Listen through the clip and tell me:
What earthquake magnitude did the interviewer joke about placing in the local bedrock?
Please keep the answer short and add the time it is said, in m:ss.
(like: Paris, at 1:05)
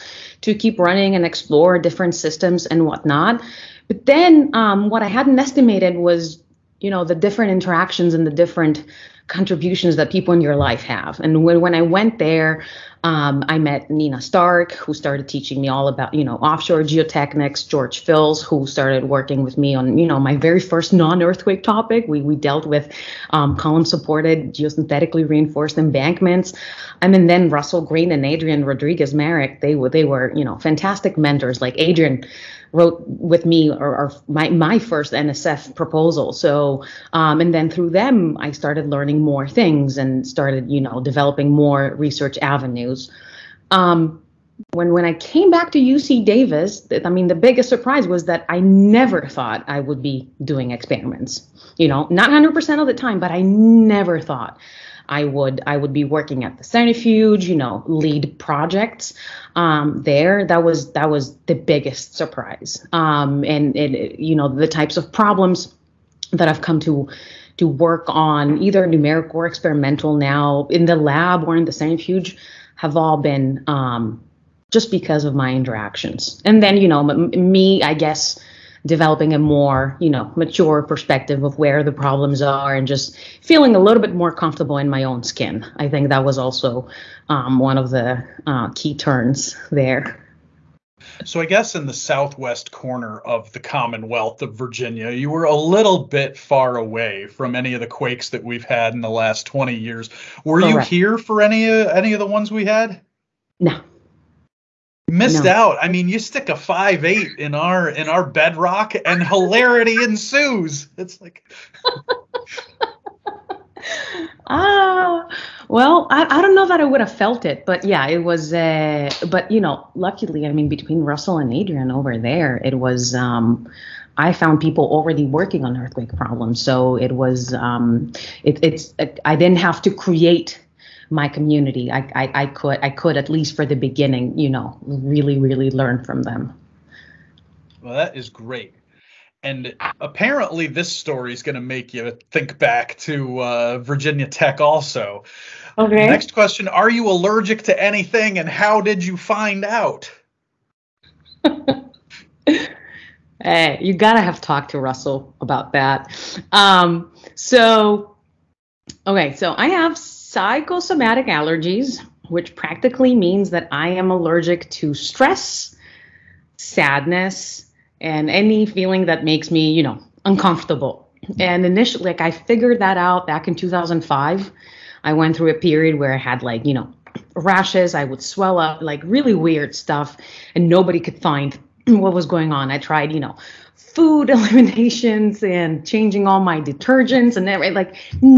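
5.8, at 1:46.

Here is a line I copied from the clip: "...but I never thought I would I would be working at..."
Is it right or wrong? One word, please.
right.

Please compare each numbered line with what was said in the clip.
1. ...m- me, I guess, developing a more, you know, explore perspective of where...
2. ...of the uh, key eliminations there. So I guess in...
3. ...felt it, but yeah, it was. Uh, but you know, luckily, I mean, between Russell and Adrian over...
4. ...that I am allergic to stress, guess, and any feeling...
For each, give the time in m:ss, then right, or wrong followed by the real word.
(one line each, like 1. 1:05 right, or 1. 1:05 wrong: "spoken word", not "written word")
1. 1:17 wrong: "mature", not "explore"
2. 1:27 wrong: "turns", not "eliminations"
3. 1:57 right
4. 2:43 wrong: "sadness", not "guess".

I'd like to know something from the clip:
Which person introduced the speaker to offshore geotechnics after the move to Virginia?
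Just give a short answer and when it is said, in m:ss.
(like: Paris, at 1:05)
Nina Stark, at 0:13.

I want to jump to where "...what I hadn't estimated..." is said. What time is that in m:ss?
0:04.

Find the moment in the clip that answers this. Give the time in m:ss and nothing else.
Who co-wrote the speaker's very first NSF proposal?
0:31.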